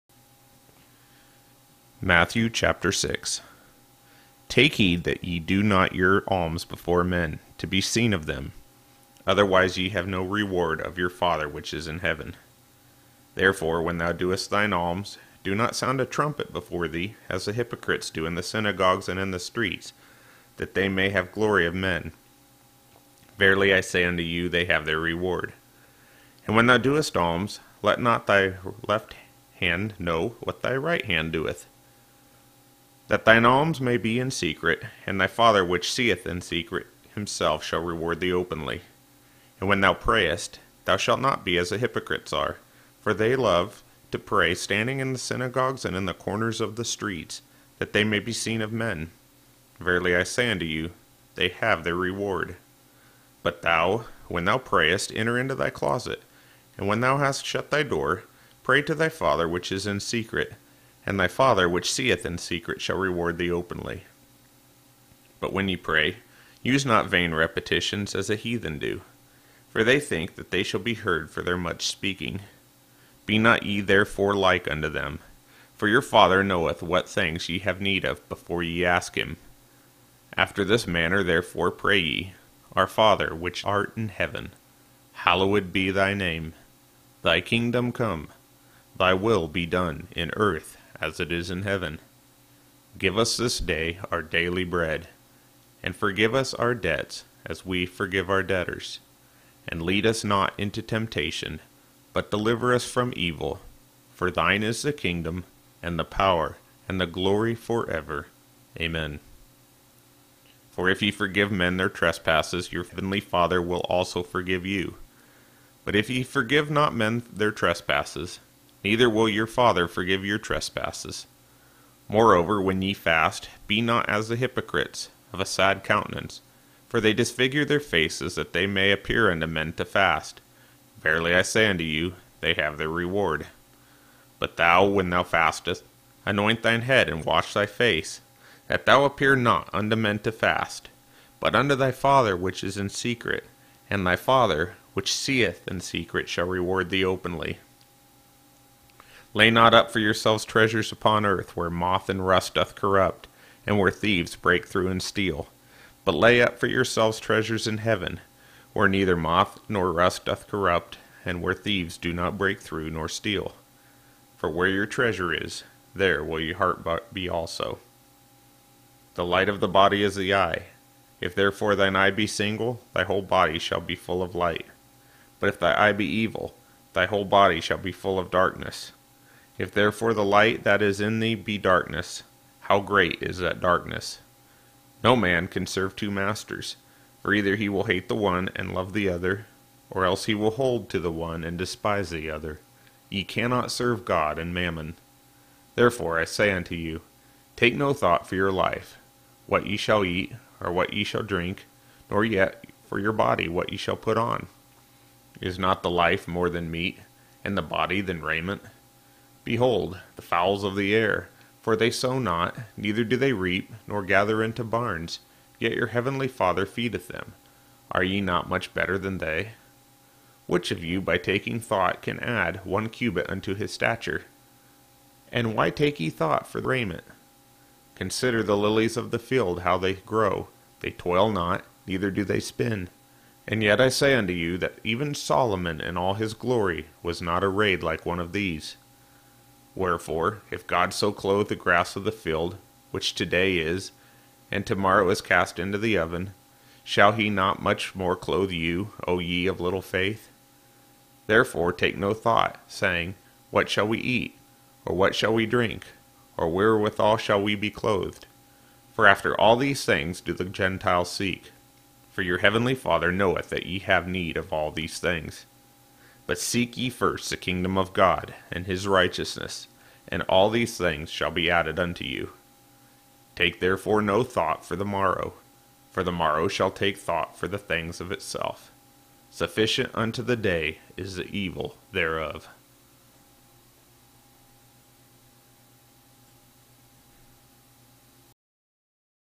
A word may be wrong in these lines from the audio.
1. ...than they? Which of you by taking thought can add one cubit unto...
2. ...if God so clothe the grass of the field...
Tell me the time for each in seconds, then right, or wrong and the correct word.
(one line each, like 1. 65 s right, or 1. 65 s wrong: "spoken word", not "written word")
1. 218 s right
2. 240 s right.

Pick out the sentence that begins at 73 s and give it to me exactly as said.
Be not ye therefore like unto them, for your Father knoweth what things ye have need of before ye ask him.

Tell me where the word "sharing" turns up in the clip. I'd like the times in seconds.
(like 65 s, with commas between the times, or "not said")
not said.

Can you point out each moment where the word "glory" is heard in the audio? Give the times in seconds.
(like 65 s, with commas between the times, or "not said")
21 s, 107 s, 236 s.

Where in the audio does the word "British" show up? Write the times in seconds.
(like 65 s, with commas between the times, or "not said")
not said.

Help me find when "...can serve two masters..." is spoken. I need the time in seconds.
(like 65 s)
185 s.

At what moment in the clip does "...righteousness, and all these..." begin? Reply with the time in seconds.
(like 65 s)
268 s.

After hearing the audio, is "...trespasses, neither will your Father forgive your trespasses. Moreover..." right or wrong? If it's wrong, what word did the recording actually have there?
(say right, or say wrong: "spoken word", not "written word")
right.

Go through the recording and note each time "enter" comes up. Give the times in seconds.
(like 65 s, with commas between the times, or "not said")
55 s.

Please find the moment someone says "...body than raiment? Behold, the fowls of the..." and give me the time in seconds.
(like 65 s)
207 s.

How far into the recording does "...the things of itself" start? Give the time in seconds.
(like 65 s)
277 s.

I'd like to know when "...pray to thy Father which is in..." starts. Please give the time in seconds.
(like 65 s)
58 s.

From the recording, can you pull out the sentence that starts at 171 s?
If therefore thine eye be single, thy whole body shall be full of light.